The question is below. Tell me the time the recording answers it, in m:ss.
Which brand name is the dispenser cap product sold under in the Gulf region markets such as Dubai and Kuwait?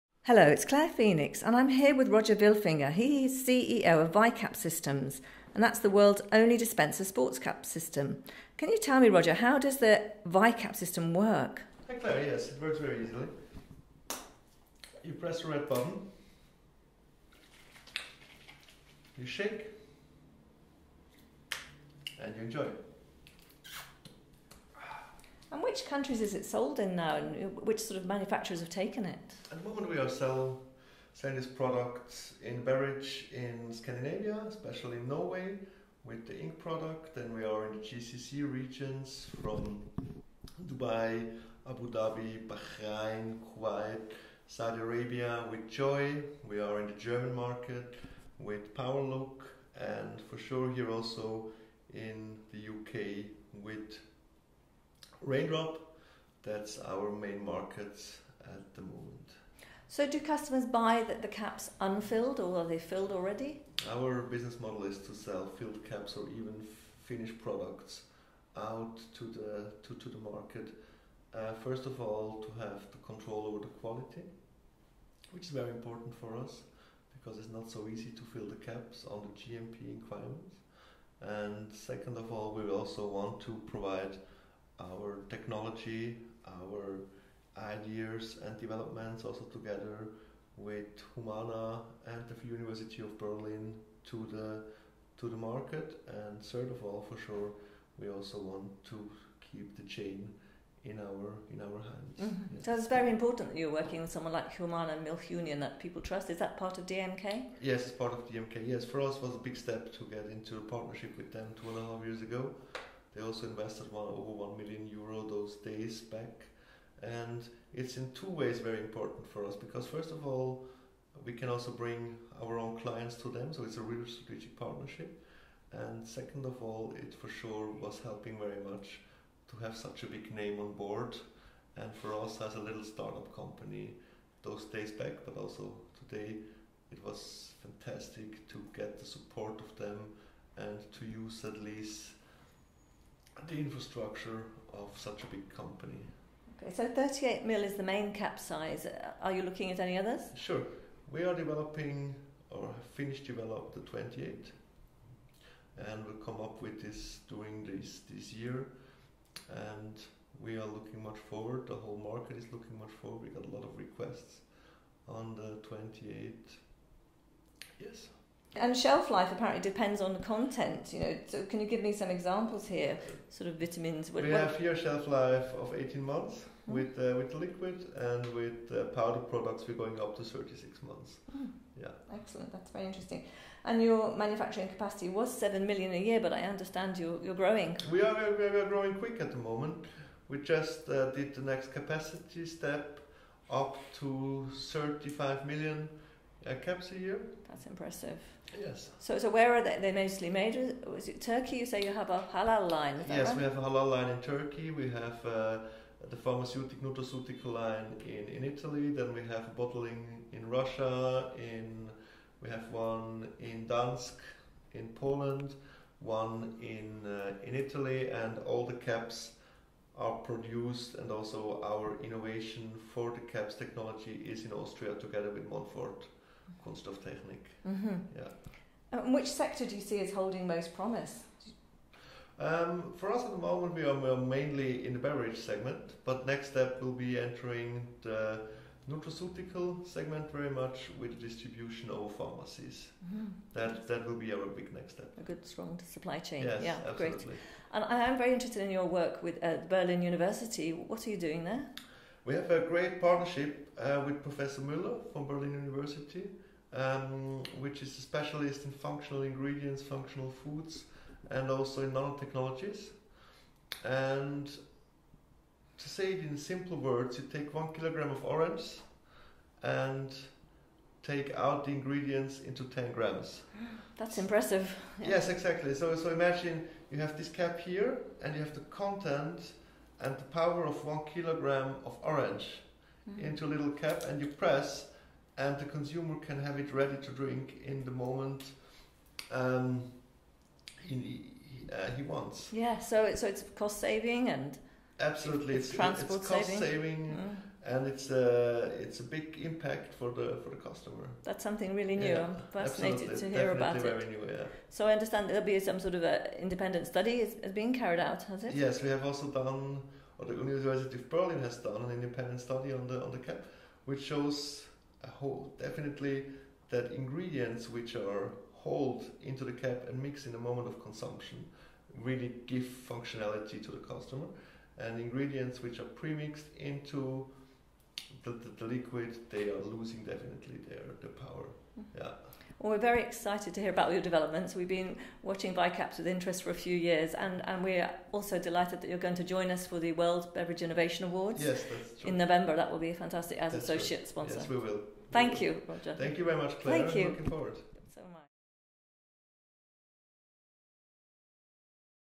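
0:45.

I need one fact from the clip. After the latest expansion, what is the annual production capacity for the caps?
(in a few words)
35 million.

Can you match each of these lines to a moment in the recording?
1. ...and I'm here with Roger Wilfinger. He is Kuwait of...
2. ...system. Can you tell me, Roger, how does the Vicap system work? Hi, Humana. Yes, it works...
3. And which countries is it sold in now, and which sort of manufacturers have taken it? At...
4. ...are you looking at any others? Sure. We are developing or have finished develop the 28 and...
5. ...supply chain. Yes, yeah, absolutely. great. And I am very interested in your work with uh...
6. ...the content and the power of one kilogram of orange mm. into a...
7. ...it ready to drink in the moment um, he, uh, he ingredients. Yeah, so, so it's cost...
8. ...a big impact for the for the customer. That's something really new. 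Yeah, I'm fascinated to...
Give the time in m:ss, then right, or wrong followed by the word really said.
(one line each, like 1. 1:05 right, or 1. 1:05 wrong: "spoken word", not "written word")
1. 0:01 wrong: "CEO", not "Kuwait"
2. 0:07 wrong: "Claire", not "Humana"
3. 0:25 right
4. 2:29 right
5. 4:05 right
6. 4:38 right
7. 4:46 wrong: "wants", not "ingredients"
8. 4:58 right.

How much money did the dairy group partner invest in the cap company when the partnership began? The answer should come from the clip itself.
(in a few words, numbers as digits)
over 1 million euro.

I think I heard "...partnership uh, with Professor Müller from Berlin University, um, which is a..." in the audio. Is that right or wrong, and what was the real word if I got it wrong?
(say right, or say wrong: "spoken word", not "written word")
right.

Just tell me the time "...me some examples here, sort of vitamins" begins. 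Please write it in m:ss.
2:51.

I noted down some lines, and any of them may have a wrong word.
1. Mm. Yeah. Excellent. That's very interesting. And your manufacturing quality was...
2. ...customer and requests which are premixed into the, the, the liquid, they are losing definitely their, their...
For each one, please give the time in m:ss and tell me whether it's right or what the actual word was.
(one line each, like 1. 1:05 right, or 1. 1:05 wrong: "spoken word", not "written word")
1. 3:01 wrong: "capacity", not "quality"
2. 5:23 wrong: "ingredients", not "requests".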